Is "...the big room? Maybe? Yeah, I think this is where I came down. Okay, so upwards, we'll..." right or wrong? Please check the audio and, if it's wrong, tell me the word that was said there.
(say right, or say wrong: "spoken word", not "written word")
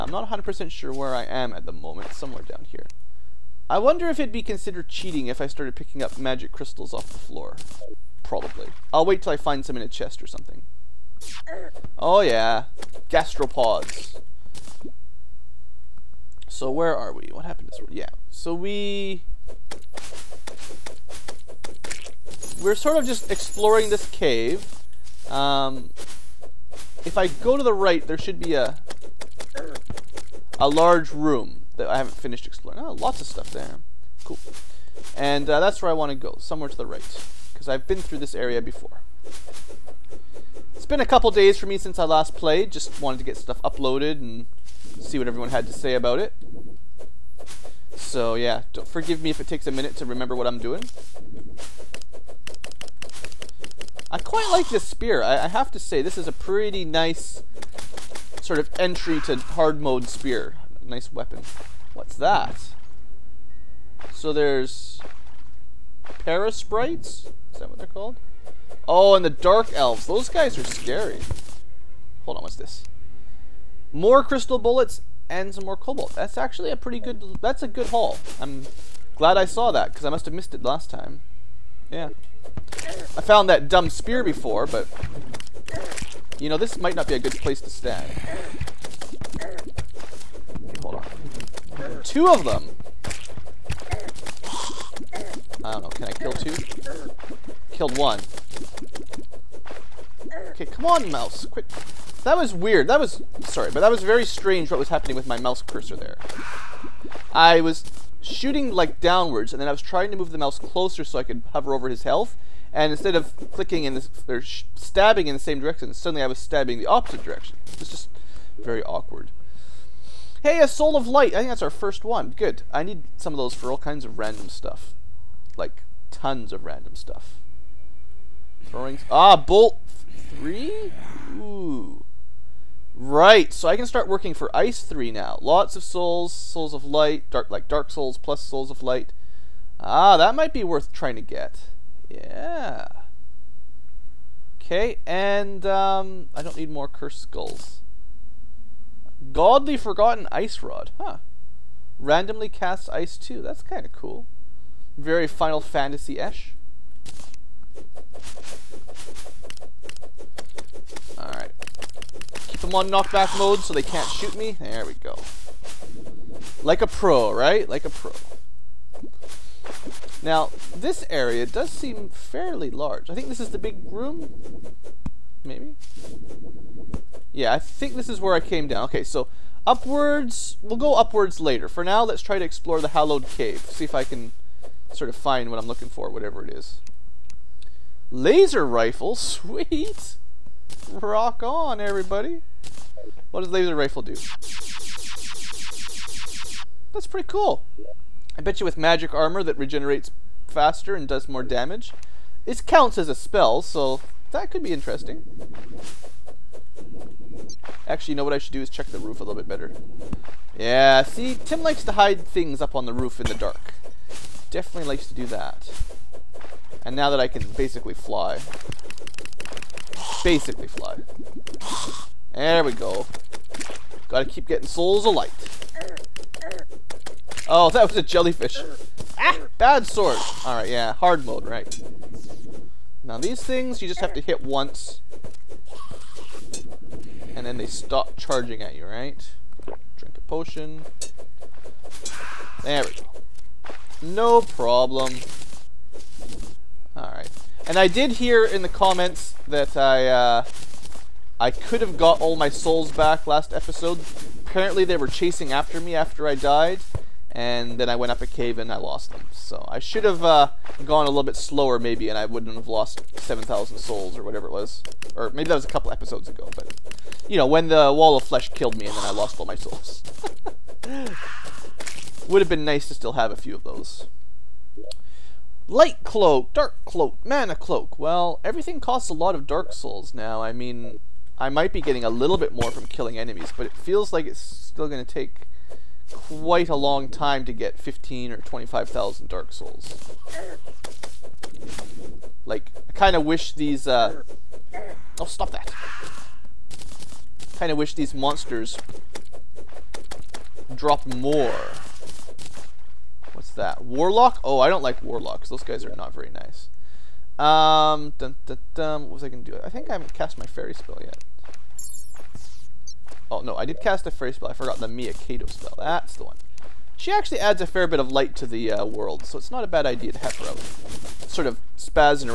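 right.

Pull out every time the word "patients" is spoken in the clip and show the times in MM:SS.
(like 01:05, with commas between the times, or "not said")
not said.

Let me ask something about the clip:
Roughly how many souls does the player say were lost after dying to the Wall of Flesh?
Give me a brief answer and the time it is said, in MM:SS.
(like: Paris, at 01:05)
7,000, at 04:23.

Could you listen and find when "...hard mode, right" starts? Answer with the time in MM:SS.
03:50.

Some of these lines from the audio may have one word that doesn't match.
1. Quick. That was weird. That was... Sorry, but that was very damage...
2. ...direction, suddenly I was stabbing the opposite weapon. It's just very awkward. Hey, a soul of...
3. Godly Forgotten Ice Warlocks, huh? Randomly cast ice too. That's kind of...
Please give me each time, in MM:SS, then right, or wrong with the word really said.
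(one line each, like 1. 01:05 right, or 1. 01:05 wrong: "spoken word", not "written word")
1. 01:41 wrong: "strange", not "damage"
2. 01:55 wrong: "direction", not "weapon"
3. 02:29 wrong: "Rod", not "Warlocks".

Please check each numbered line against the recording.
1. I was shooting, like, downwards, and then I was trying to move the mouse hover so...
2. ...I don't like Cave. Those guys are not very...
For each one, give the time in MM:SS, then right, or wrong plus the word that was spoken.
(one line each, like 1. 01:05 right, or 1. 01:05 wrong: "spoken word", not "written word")
1. 01:47 wrong: "closer", not "hover"
2. 05:04 wrong: "Warlocks", not "Cave".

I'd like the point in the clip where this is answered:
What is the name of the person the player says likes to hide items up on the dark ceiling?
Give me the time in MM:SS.
03:31.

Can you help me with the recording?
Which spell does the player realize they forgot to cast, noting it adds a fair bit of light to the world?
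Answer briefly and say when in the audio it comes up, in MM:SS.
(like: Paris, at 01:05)
Kato spell, at 05:15.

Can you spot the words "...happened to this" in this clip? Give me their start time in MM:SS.
00:17.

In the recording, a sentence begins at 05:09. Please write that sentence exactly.
I think I haven't cast my Fairy spell yet.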